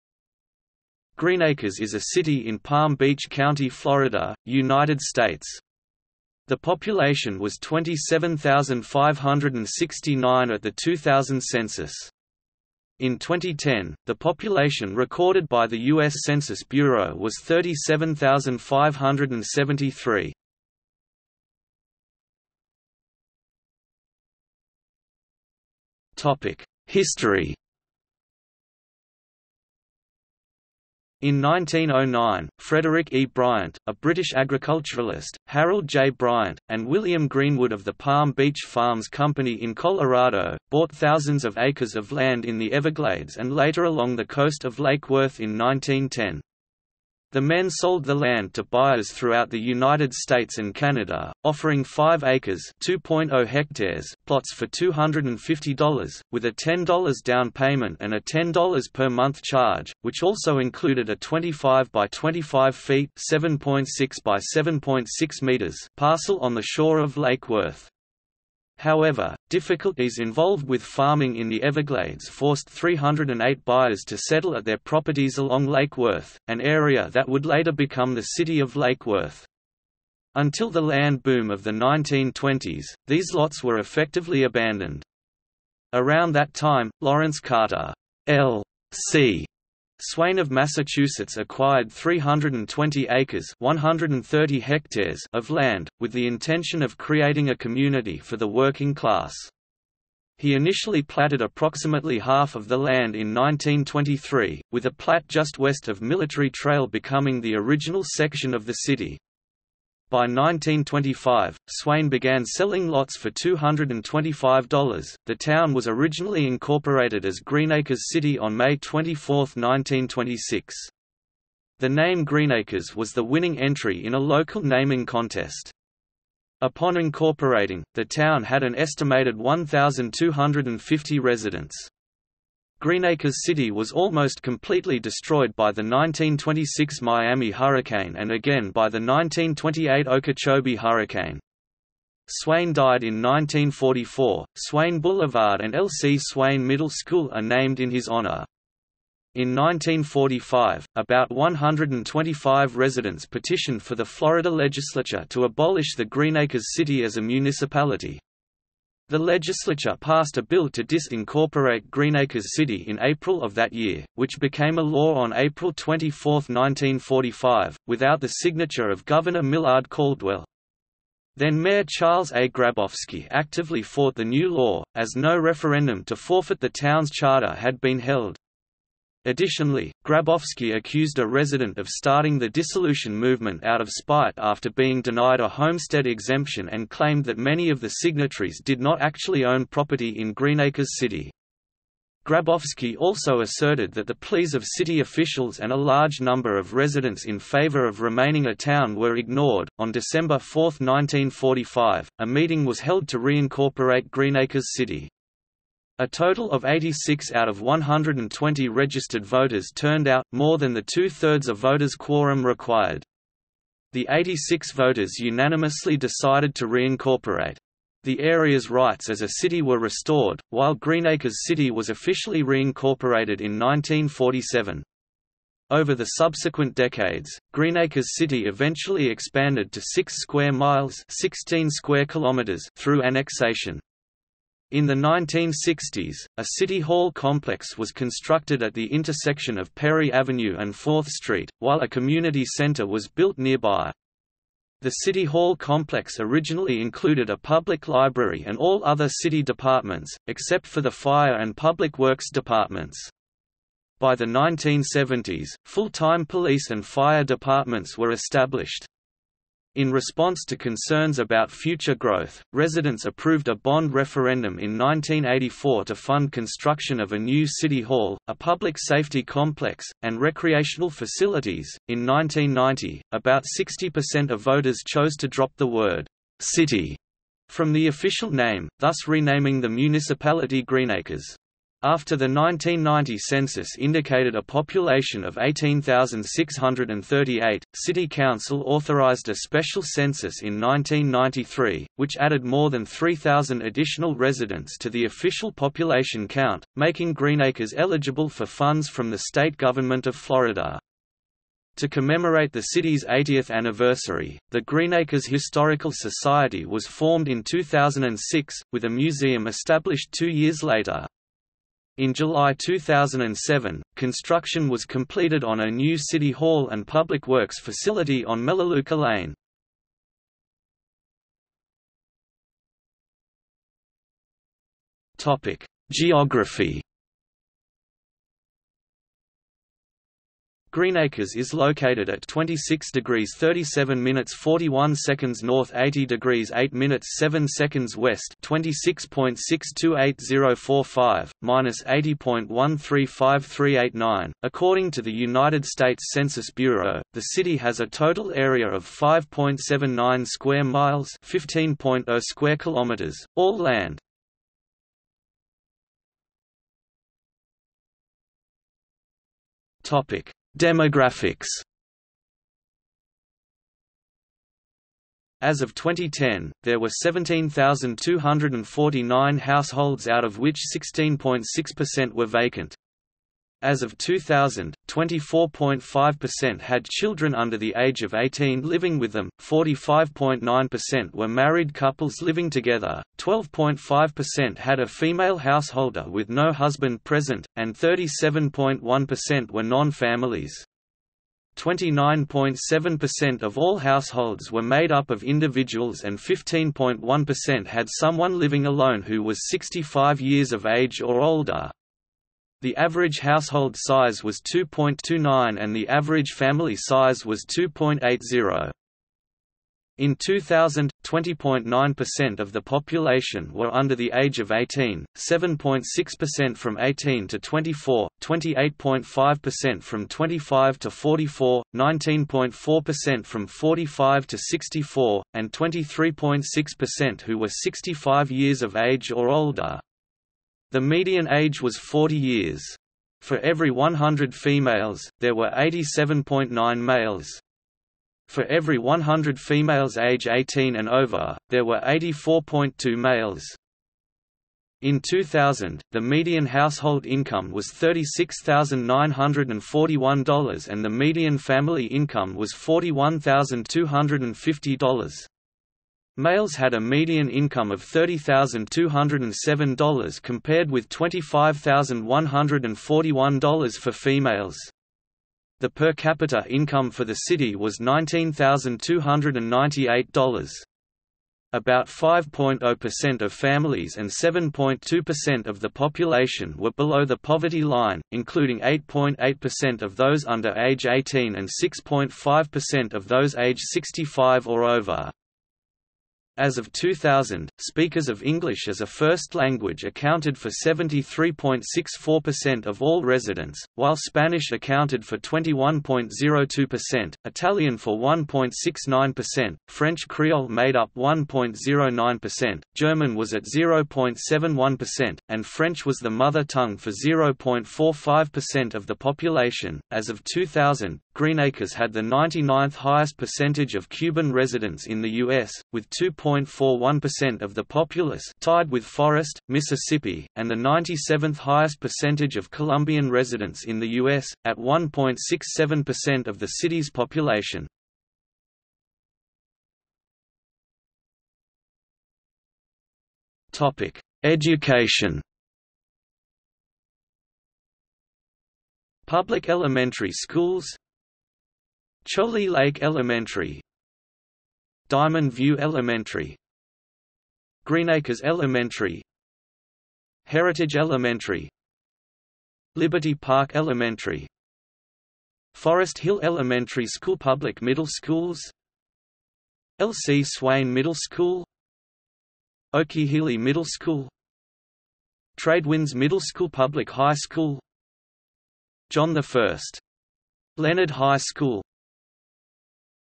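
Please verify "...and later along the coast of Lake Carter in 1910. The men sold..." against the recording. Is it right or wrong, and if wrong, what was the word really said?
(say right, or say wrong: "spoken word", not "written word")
wrong: "Worth", not "Carter".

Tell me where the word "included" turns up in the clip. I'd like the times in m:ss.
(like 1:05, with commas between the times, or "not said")
1:00, 4:06.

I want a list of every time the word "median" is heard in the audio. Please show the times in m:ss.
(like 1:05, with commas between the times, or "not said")
7:10, 7:25, 7:30.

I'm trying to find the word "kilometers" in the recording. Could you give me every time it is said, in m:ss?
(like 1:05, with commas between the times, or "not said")
3:52, 5:52.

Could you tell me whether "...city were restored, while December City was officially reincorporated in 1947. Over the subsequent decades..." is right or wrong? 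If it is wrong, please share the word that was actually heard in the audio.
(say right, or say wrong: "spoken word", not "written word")
wrong: "Greenacres", not "December".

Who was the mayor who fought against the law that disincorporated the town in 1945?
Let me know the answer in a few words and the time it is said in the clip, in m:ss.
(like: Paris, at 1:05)
Charles A. Grabowski, at 2:51.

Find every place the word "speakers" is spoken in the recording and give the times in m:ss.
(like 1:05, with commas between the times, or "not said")
8:07.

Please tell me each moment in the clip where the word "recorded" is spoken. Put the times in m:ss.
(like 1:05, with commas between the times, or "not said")
0:14.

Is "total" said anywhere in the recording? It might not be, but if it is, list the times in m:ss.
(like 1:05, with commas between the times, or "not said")
3:26, 5:47.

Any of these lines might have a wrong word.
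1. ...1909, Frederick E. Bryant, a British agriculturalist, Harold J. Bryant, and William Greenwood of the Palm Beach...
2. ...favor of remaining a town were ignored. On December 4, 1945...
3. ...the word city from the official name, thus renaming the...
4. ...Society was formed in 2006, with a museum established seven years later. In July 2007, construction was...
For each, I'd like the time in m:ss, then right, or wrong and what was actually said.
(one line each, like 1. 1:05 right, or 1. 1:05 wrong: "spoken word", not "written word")
1. 0:31 right
2. 3:17 right
3. 4:35 right
4. 5:05 wrong: "two", not "seven".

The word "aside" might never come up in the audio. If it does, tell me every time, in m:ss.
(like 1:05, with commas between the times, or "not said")
not said.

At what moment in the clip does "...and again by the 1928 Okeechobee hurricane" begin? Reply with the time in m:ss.
2:18.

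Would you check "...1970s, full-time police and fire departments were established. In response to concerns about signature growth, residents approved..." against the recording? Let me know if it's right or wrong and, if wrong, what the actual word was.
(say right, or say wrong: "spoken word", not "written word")
wrong: "future", not "signature".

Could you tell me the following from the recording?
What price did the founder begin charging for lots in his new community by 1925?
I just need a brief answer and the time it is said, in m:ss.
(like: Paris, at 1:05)
$225, at 1:53.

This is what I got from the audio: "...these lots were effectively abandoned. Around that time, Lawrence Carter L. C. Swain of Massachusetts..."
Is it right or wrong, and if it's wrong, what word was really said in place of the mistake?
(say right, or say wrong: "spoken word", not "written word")
right.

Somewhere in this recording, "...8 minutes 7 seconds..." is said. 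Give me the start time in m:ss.
5:36.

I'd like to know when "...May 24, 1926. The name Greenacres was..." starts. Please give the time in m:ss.
1:58.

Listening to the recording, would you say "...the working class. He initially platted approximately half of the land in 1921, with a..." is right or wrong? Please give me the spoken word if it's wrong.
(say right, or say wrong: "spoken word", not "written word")
wrong: "1923", not "1921".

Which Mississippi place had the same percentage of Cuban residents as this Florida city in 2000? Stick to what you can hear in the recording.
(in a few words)
Forest, Mississippi.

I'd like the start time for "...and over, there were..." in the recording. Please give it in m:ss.
7:20.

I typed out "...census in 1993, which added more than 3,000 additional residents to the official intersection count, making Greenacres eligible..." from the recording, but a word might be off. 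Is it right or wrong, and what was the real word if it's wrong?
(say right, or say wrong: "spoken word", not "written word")
wrong: "population", not "intersection".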